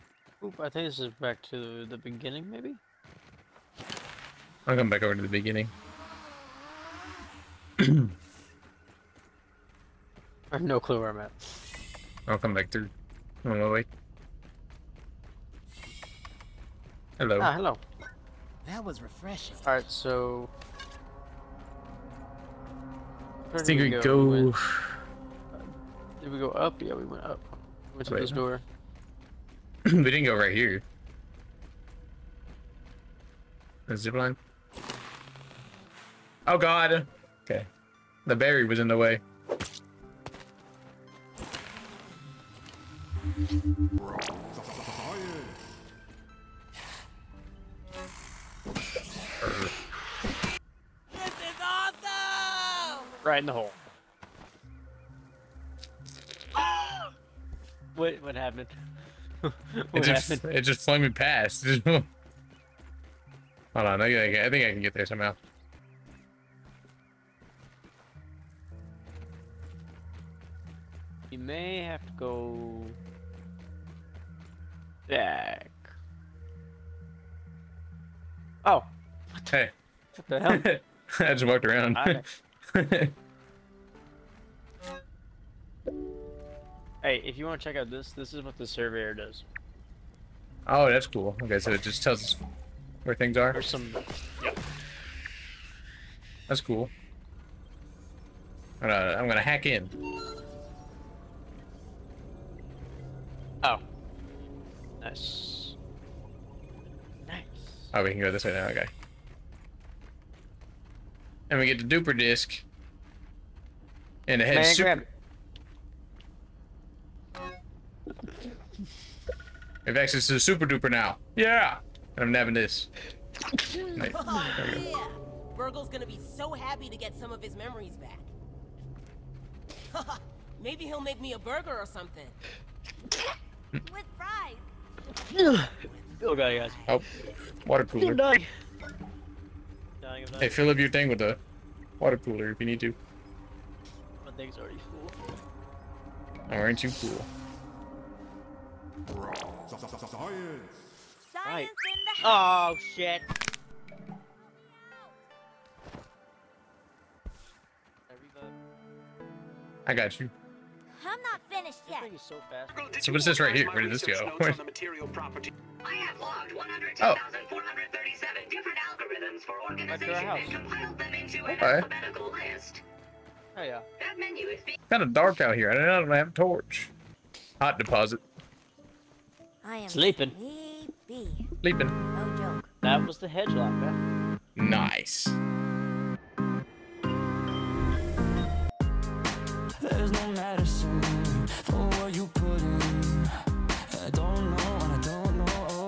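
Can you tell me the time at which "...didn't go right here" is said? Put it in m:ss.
0:30.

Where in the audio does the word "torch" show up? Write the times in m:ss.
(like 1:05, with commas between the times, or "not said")
2:56.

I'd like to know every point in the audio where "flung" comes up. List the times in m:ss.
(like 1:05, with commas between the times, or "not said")
1:00.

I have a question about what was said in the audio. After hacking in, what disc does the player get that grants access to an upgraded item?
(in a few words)
duper disc.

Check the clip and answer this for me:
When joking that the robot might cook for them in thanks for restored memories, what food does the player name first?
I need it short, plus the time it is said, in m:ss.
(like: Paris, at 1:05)
burger, at 2:11.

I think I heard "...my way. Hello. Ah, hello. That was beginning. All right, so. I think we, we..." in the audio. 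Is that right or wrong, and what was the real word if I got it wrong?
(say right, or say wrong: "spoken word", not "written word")
wrong: "refreshing", not "beginning".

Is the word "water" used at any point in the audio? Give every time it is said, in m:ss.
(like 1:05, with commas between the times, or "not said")
2:17, 2:21.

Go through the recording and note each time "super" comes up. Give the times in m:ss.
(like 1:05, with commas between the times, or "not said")
1:54, 2:00.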